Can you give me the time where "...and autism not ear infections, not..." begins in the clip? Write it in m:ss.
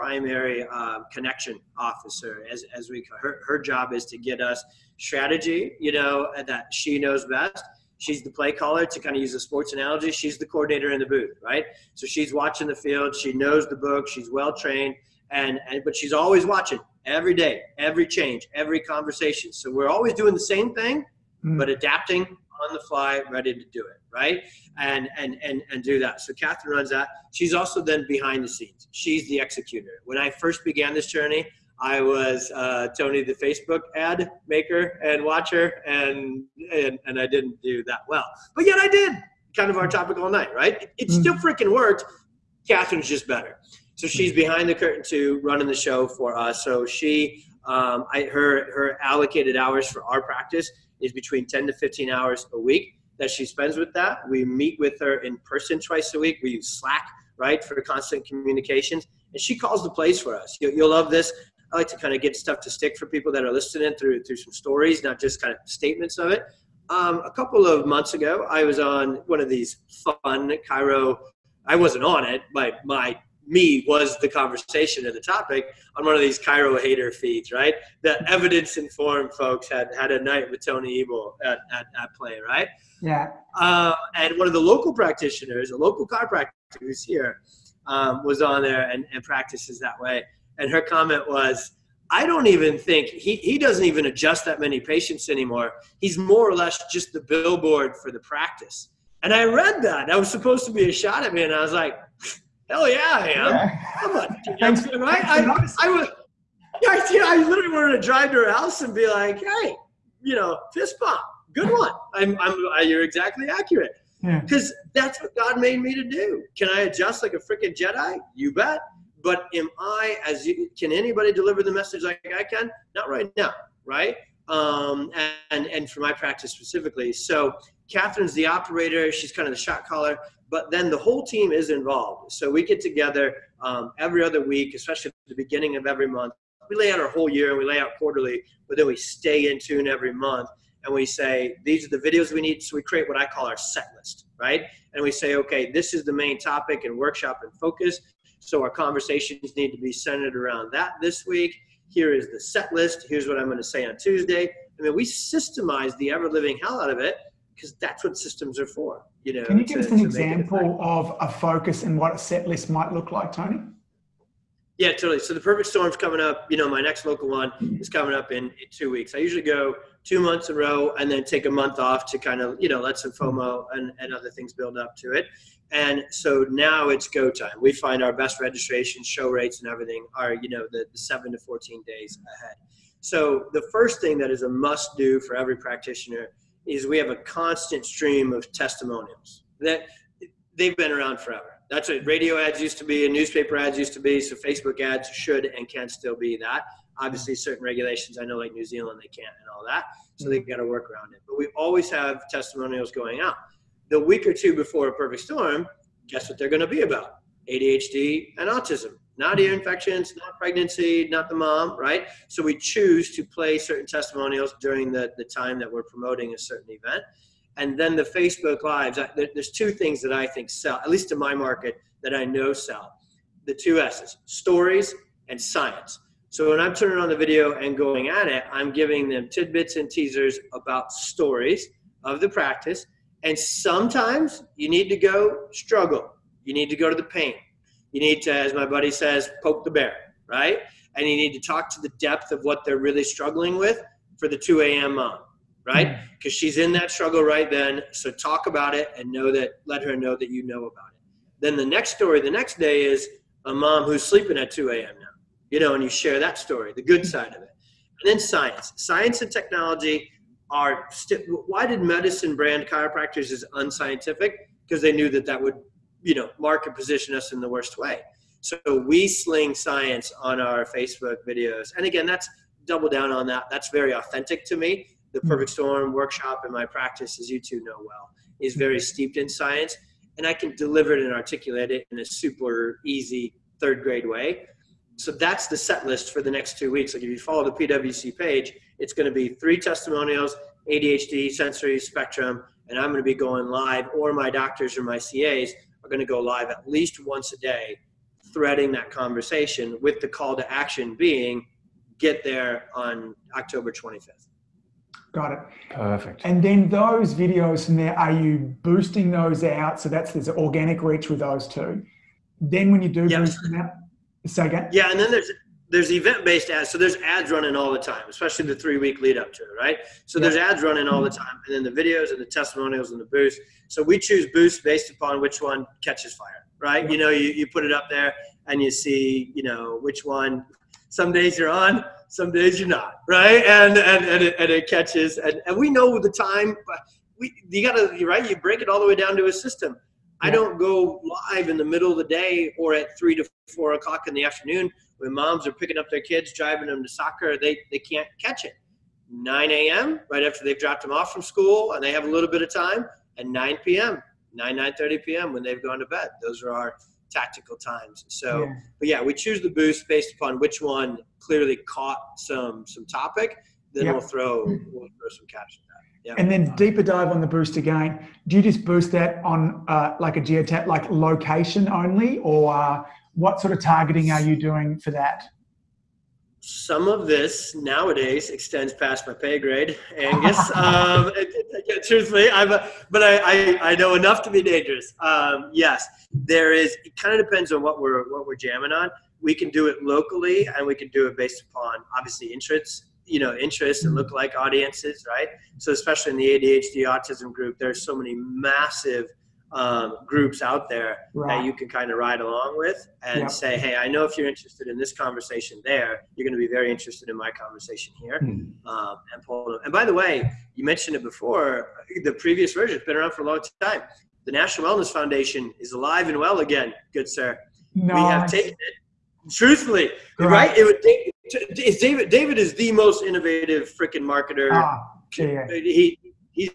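3:28.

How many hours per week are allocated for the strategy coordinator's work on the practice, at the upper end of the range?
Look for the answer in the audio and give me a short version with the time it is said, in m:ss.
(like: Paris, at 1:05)
15, at 0:51.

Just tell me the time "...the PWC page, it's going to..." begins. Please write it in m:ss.
4:47.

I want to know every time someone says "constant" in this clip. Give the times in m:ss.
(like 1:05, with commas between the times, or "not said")
0:57, 3:07.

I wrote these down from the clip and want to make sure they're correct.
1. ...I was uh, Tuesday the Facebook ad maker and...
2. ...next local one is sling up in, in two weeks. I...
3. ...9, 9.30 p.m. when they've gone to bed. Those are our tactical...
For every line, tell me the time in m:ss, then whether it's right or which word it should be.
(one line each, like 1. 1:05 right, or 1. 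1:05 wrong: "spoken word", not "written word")
1. 0:31 wrong: "Tony", not "Tuesday"
2. 2:46 wrong: "coming", not "sling"
3. 5:54 right.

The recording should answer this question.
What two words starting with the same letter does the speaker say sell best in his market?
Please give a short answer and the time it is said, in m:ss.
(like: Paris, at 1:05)
stories and science, at 3:44.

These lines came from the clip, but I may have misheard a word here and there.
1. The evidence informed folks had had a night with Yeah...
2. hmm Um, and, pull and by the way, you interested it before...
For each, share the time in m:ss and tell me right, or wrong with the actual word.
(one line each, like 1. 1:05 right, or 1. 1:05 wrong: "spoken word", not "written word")
1. 1:18 wrong: "Tony", not "Yeah"
2. 6:48 wrong: "mentioned", not "interested".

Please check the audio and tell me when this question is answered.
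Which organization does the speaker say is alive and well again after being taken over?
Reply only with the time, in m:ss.
6:54.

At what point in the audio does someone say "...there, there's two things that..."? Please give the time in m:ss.
3:39.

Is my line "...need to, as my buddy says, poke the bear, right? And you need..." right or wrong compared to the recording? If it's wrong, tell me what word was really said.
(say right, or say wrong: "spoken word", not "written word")
right.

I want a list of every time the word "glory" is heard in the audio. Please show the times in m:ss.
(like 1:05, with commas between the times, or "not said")
not said.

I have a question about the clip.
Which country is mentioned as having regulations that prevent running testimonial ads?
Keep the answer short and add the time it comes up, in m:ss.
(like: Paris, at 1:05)
New Zealand, at 3:18.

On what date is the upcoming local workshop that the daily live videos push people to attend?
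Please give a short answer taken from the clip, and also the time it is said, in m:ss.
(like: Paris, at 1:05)
October 25th, at 5:03.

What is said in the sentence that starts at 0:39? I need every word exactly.
Kind of our topic all night, right?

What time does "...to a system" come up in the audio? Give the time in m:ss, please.
5:39.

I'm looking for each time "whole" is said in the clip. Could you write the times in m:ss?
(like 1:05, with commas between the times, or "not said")
2:10, 2:17.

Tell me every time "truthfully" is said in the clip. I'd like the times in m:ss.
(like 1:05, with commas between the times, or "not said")
6:21, 6:59.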